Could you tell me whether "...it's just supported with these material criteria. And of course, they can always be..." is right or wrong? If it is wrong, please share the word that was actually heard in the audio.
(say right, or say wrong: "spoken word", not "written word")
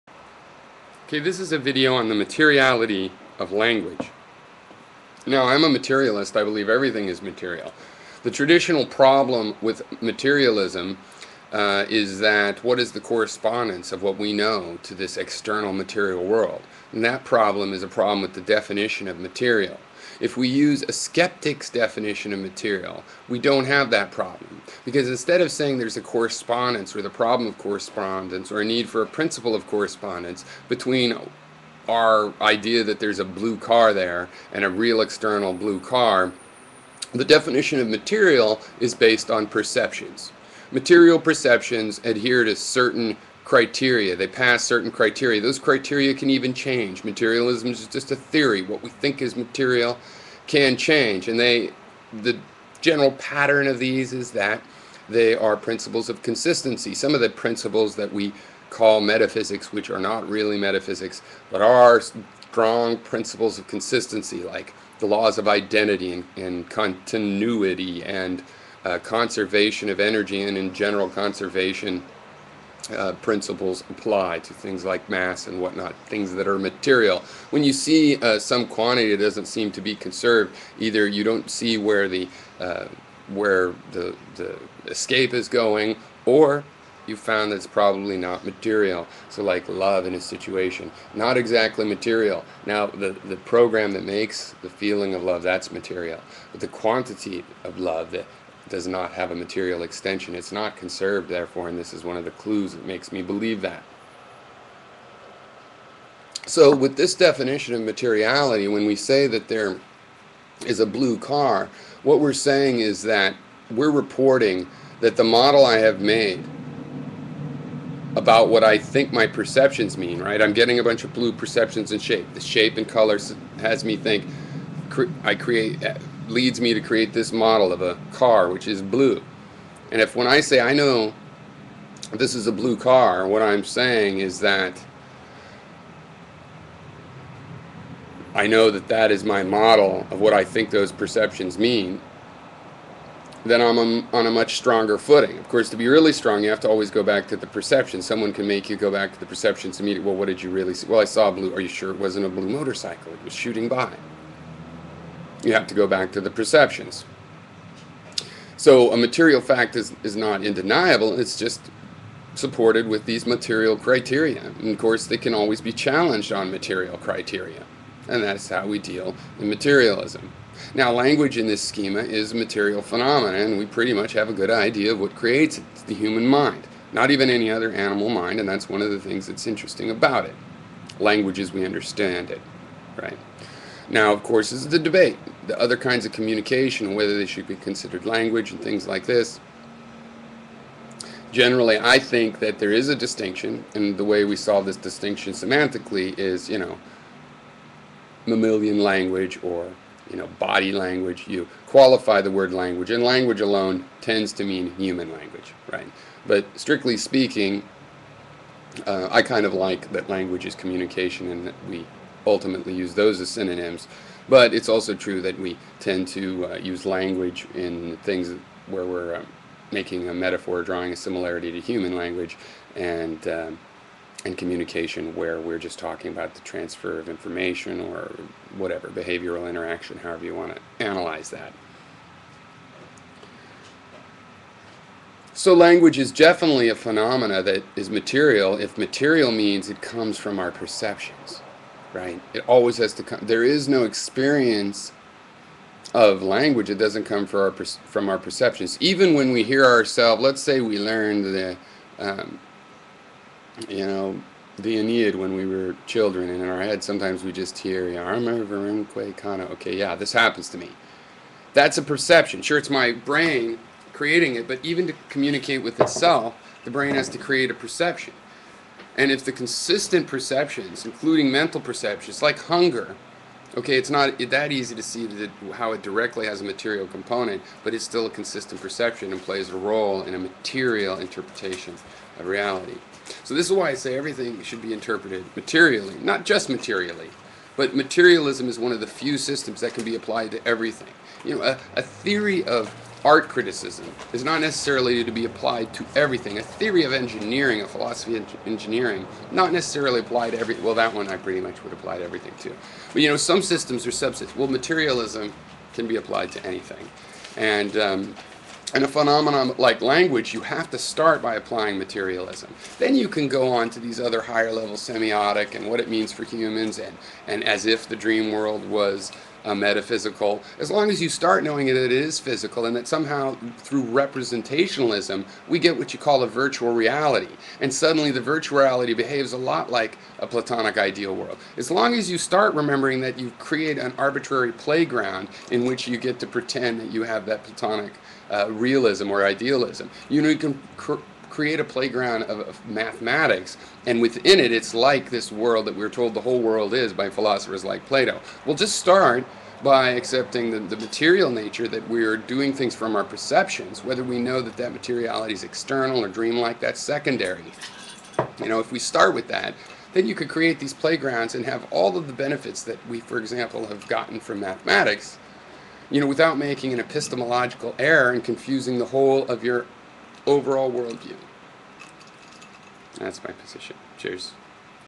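right.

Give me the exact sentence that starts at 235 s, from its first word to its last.
So language is definitely a phenomena that is material if material means it comes from our perceptions right?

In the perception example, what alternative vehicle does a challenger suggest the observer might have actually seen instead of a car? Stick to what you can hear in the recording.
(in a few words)
A blue motorcycle.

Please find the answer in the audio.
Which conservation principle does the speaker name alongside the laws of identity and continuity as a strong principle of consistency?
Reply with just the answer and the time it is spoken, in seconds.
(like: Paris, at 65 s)
Conservation of energy, at 68 s.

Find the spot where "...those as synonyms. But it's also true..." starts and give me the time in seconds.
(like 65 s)
212 s.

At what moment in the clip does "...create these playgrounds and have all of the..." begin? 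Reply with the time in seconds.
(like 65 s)
360 s.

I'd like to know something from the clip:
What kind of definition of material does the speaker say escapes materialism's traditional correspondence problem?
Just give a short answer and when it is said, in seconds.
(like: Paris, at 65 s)
A skeptic's definition, at 20 s.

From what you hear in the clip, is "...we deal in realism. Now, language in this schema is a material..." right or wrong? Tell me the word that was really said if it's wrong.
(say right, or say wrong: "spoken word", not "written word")
wrong: "materialism", not "realism".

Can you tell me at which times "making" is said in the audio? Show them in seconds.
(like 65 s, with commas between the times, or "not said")
219 s, 366 s.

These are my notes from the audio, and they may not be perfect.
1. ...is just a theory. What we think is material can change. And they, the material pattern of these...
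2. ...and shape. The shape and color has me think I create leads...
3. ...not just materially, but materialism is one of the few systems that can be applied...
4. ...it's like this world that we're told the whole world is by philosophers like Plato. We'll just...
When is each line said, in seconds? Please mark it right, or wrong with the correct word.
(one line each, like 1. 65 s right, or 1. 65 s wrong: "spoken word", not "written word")
1. 47 s wrong: "general", not "material"
2. 121 s right
3. 286 s right
4. 344 s right.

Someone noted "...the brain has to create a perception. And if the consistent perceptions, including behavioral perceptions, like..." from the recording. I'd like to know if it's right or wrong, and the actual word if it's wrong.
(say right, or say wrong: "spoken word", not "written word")
wrong: "mental", not "behavioral".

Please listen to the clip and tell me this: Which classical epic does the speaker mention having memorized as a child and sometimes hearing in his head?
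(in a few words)
The Aeneid.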